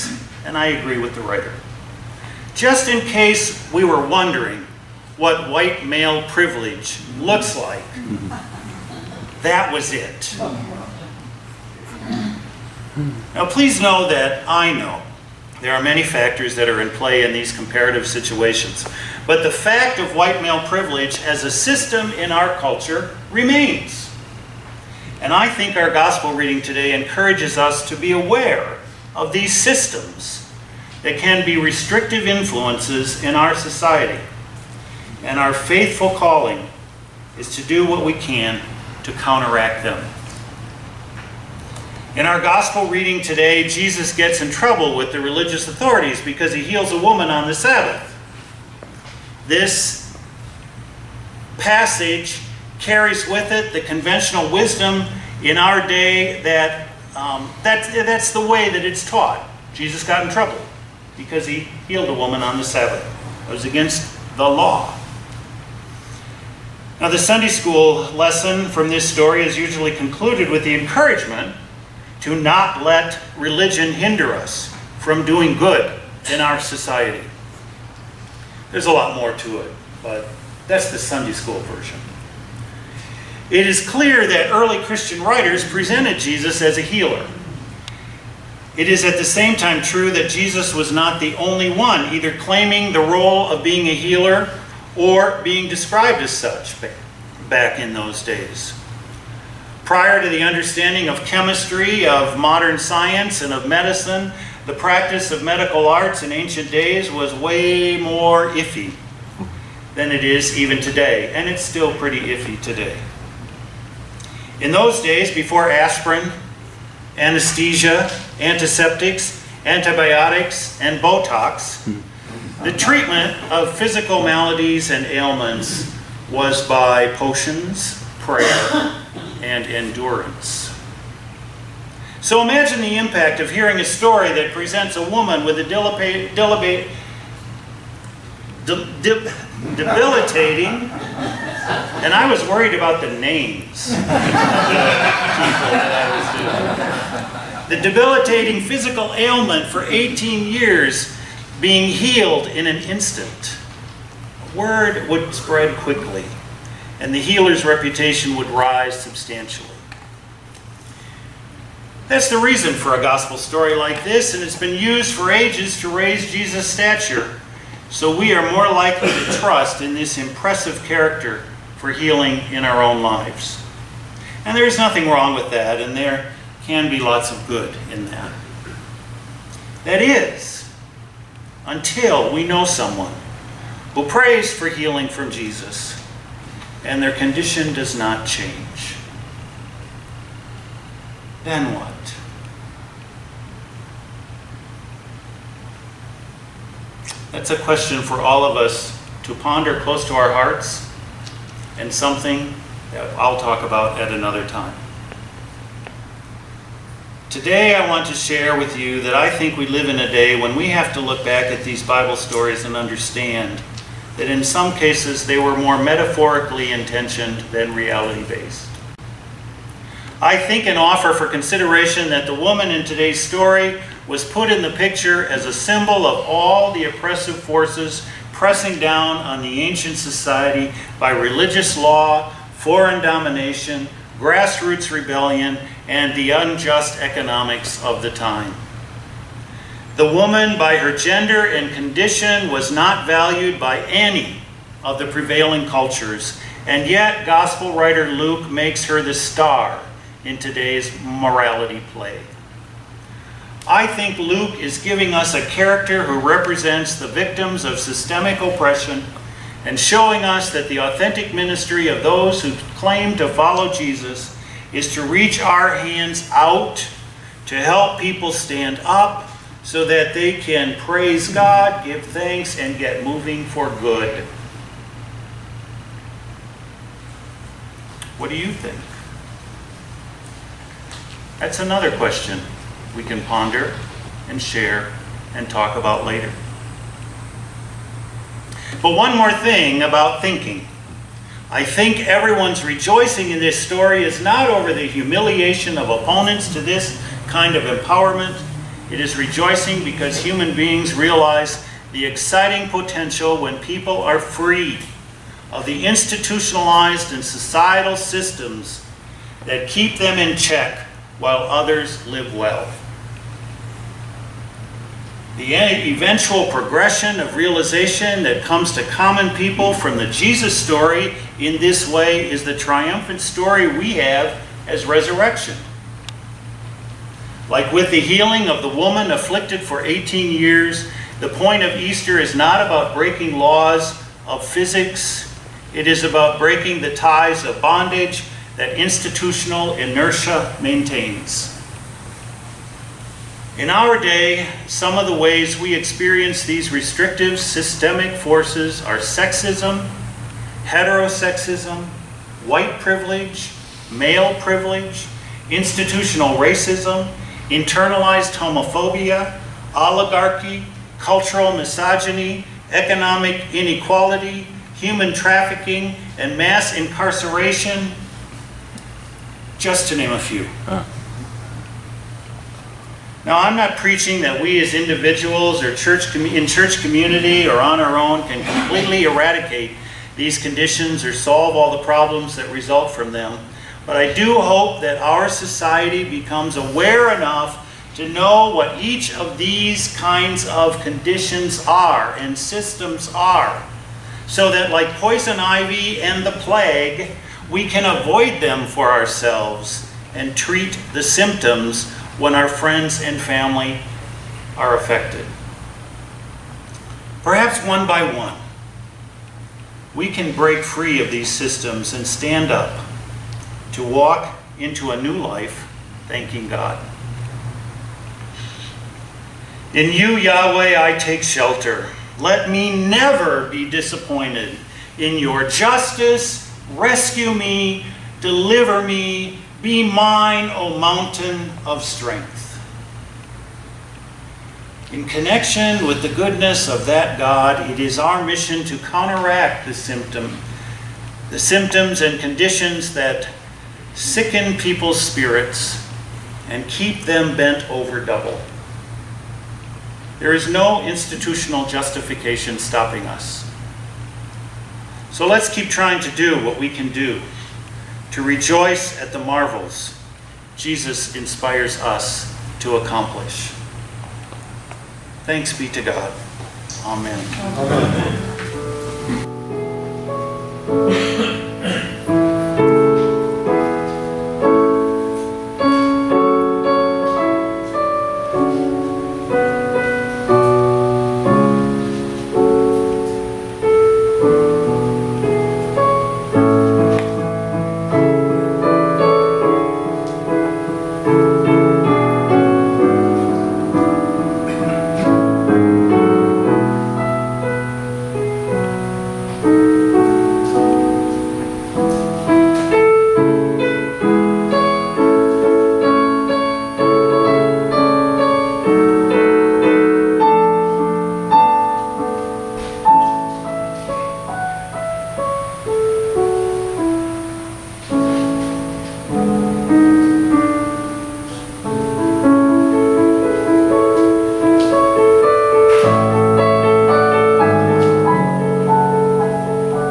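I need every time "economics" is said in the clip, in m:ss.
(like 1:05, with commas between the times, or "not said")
3:57, 6:02.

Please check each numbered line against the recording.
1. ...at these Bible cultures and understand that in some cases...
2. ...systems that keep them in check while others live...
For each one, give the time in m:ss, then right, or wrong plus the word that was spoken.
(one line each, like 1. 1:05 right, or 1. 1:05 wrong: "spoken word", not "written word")
1. 3:31 wrong: "stories", not "cultures"
2. 5:07 right.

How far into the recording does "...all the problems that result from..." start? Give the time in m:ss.
6:21.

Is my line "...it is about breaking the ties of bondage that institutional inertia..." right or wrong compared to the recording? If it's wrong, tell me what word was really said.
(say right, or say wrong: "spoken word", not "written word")
right.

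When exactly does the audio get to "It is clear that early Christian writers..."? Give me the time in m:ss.
1:23.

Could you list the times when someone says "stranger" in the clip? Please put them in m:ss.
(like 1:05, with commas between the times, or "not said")
not said.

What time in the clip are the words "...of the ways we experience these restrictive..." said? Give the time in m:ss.
5:44.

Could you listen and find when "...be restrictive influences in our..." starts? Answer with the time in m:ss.
0:31.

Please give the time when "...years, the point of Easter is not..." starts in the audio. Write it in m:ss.
5:30.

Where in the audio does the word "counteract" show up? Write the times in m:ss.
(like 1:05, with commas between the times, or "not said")
0:39, 7:18.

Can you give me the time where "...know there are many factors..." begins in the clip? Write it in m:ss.
0:14.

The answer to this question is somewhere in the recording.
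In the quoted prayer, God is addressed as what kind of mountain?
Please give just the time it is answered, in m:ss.
7:10.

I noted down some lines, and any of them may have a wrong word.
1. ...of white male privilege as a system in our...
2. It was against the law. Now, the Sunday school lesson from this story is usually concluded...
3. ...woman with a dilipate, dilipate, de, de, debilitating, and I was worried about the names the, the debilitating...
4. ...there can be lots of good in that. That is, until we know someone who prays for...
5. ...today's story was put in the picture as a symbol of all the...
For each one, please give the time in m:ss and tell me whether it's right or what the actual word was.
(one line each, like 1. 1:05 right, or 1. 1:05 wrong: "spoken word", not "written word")
1. 0:19 right
2. 1:03 right
3. 2:15 right
4. 2:55 right
5. 3:42 right.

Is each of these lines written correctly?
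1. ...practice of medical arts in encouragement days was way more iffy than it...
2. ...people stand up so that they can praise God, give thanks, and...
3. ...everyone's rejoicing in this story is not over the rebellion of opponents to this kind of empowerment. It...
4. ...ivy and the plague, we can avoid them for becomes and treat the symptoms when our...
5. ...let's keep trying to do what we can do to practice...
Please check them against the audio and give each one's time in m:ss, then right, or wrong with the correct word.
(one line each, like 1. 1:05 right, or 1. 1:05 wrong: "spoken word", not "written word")
1. 1:44 wrong: "ancient", not "encouragement"
2. 4:27 right
3. 4:52 wrong: "humiliation", not "rebellion"
4. 6:35 wrong: "ourselves", not "becomes"
5. 7:35 wrong: "rejoice", not "practice".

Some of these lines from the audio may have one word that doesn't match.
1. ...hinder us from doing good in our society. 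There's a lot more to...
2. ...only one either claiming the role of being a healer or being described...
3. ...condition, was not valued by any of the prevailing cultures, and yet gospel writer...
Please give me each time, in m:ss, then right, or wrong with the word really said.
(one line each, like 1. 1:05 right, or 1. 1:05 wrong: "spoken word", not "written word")
1. 1:13 right
2. 1:31 right
3. 4:01 right.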